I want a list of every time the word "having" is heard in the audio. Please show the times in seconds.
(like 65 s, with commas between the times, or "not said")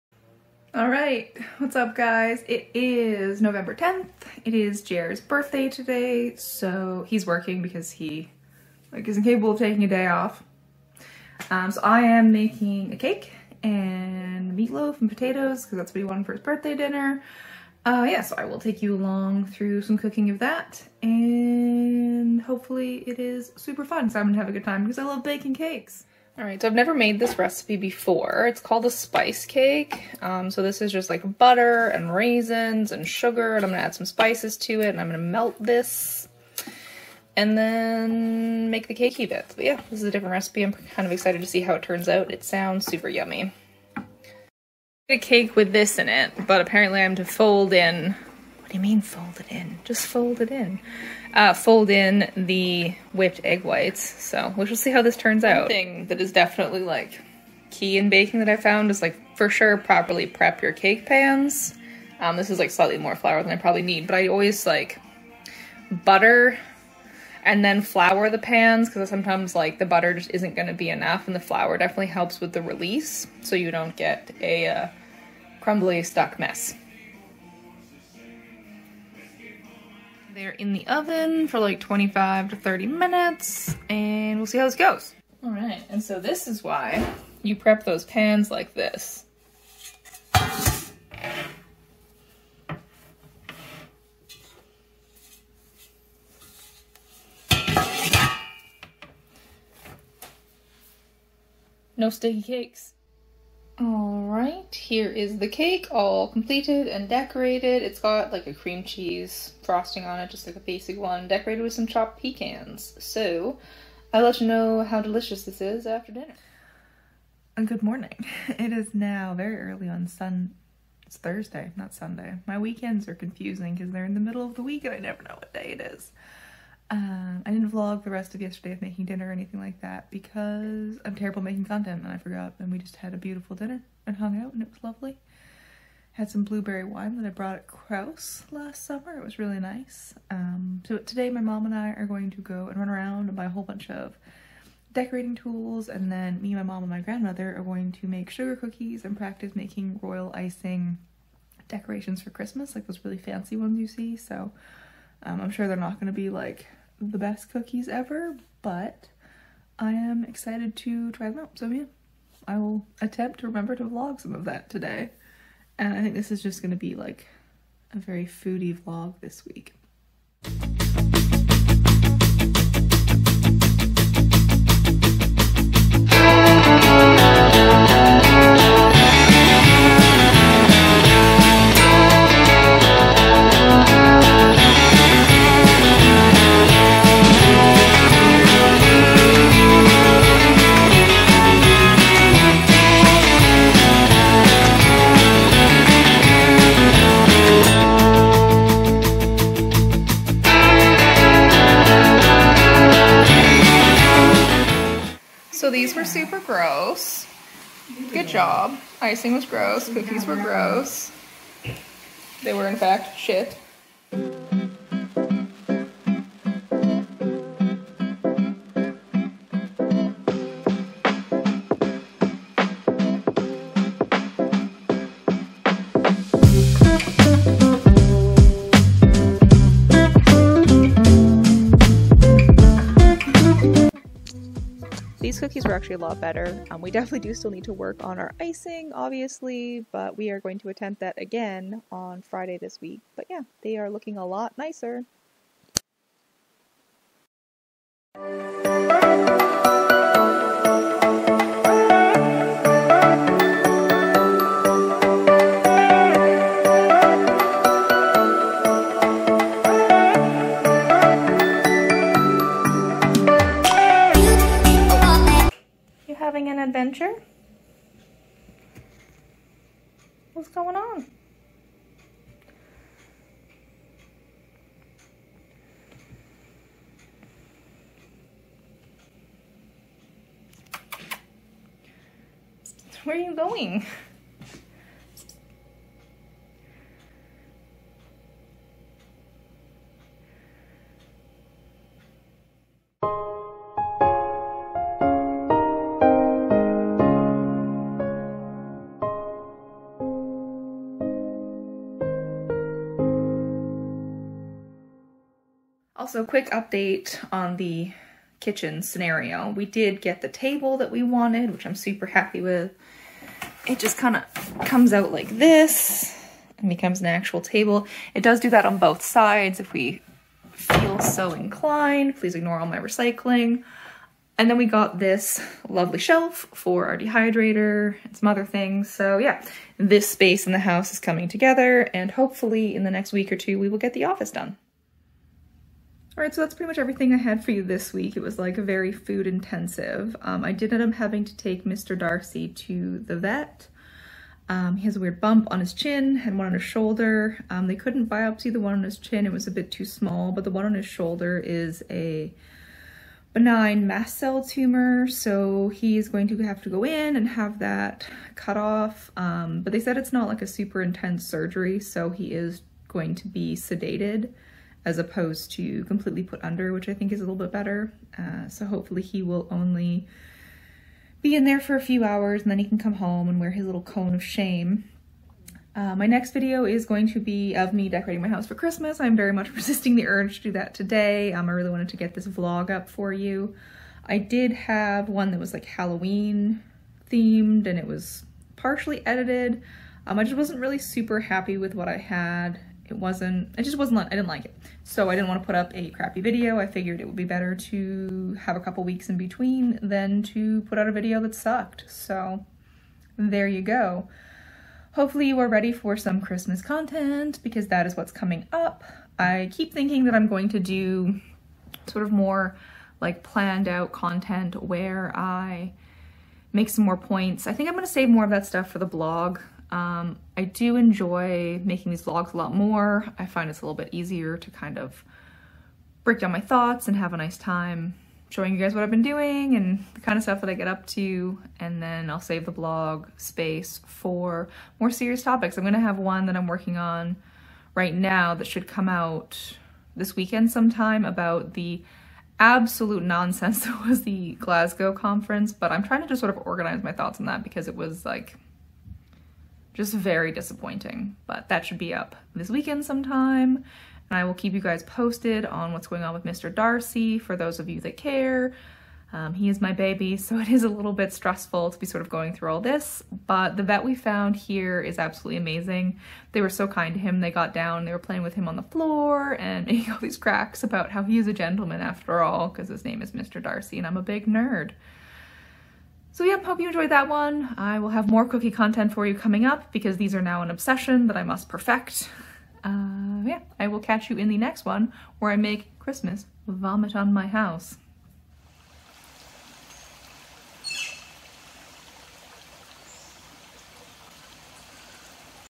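266 s, 340 s.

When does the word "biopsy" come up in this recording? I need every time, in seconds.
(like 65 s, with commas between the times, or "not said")
348 s.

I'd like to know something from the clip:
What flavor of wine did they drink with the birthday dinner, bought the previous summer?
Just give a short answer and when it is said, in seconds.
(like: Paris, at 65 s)
Blueberry, at 136 s.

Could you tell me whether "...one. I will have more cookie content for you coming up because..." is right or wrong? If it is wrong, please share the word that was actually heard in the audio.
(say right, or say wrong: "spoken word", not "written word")
right.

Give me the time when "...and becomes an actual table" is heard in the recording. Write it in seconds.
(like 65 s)
316 s.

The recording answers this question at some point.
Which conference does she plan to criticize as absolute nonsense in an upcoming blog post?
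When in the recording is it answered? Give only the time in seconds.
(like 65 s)
444 s.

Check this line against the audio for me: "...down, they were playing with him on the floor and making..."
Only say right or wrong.
right.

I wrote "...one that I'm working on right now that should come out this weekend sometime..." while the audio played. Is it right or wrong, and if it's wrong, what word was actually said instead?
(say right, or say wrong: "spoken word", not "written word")
right.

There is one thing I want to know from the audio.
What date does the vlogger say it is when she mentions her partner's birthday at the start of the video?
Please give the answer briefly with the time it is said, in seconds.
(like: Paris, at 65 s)
November 10th, at 3 s.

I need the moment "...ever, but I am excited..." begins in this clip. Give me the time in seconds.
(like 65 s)
157 s.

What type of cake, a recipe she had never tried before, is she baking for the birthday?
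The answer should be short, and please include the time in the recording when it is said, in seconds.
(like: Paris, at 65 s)
Spice cake, at 28 s.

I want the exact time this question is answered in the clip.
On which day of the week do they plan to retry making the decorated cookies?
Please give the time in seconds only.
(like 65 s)
242 s.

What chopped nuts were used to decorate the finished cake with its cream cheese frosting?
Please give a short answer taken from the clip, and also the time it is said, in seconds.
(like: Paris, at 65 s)
Pecans, at 112 s.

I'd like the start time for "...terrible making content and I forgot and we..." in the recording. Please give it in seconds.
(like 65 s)
131 s.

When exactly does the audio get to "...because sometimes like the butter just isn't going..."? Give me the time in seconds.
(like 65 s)
68 s.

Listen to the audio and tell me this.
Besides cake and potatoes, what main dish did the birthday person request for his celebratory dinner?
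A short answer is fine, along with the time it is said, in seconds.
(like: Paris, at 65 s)
Meatloaf, at 14 s.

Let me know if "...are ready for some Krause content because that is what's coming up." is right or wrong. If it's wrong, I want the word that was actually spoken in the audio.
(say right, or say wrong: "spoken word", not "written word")
wrong: "Christmas", not "Krause".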